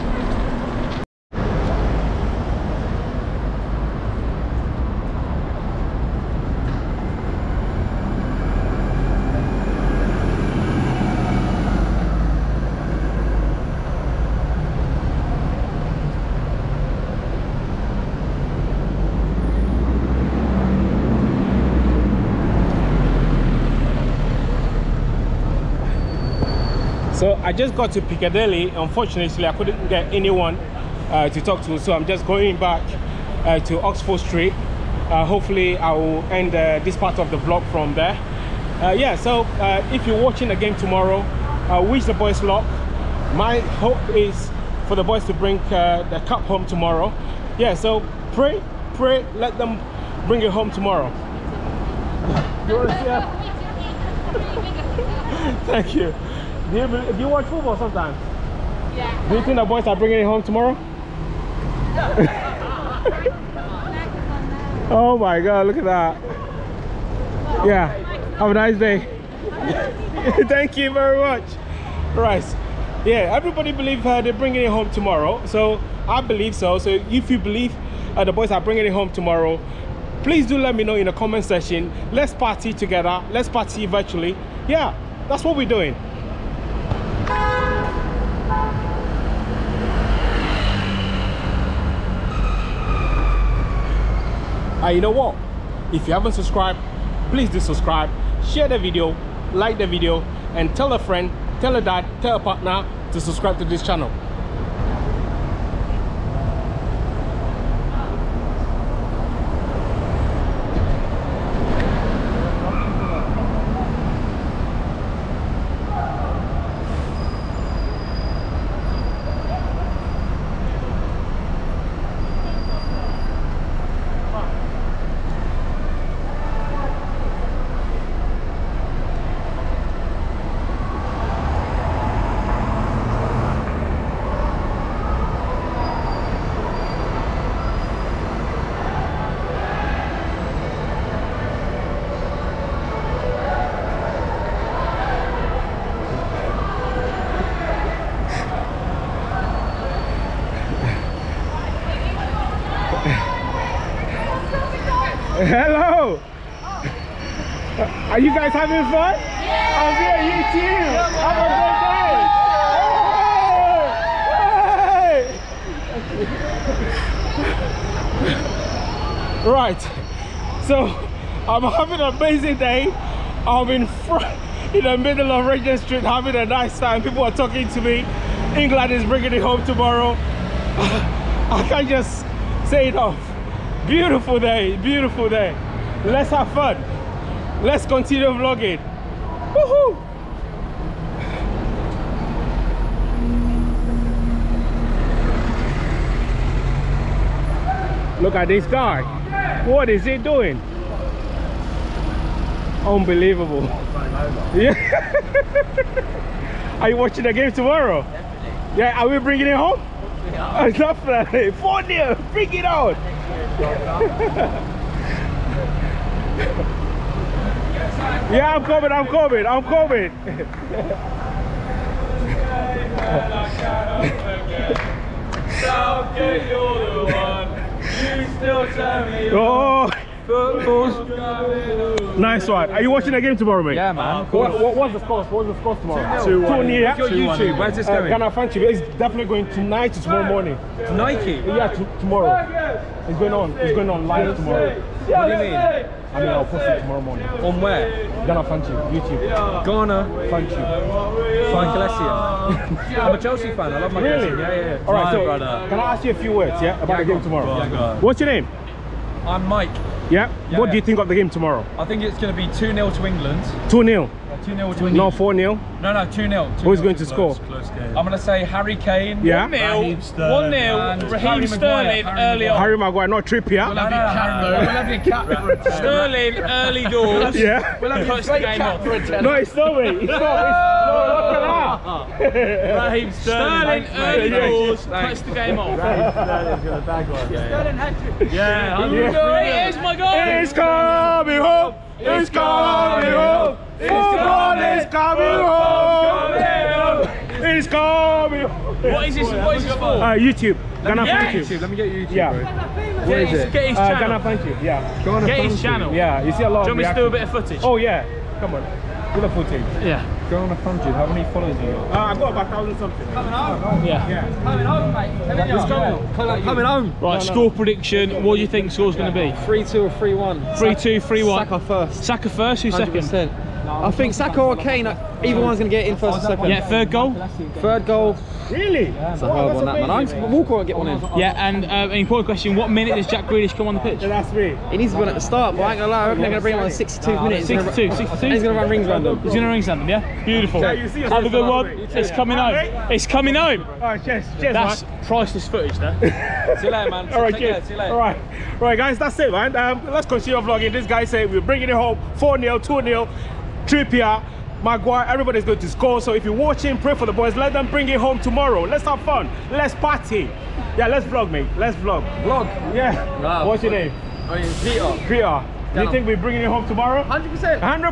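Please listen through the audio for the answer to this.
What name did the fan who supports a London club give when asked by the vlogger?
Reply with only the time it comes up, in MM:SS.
04:19.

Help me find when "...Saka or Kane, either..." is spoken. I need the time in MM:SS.
05:24.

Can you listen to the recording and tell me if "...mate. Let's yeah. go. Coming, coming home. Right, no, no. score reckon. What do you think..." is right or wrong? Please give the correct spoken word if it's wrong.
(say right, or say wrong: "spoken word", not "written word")
wrong: "prediction", not "reckon".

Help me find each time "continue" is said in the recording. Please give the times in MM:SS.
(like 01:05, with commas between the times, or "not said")
03:07, 05:50.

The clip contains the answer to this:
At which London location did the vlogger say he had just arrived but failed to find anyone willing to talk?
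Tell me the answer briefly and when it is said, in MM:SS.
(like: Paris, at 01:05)
Piccadilly, at 00:28.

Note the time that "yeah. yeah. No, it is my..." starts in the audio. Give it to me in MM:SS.
04:48.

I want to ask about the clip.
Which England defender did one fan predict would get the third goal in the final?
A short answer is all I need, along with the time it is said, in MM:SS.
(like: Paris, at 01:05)
Kyle Walker, at 05:30.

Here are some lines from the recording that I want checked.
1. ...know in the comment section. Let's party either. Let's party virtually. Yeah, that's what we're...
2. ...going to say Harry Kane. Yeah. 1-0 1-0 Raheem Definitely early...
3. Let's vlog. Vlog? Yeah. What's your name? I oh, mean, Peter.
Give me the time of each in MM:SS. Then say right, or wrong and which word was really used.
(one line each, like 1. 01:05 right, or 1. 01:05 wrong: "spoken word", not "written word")
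1. 01:20 wrong: "together", not "either"
2. 04:28 wrong: "Sterling", not "Definitely"
3. 06:01 right.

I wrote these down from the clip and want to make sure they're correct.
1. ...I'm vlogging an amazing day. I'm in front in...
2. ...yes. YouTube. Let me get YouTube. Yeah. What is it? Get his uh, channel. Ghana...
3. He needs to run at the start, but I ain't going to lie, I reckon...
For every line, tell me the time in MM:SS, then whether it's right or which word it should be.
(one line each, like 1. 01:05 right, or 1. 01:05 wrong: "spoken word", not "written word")
1. 02:51 wrong: "having", not "vlogging"
2. 05:01 right
3. 05:34 right.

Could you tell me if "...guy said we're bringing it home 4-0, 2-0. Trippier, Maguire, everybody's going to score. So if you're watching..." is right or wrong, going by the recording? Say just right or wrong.
right.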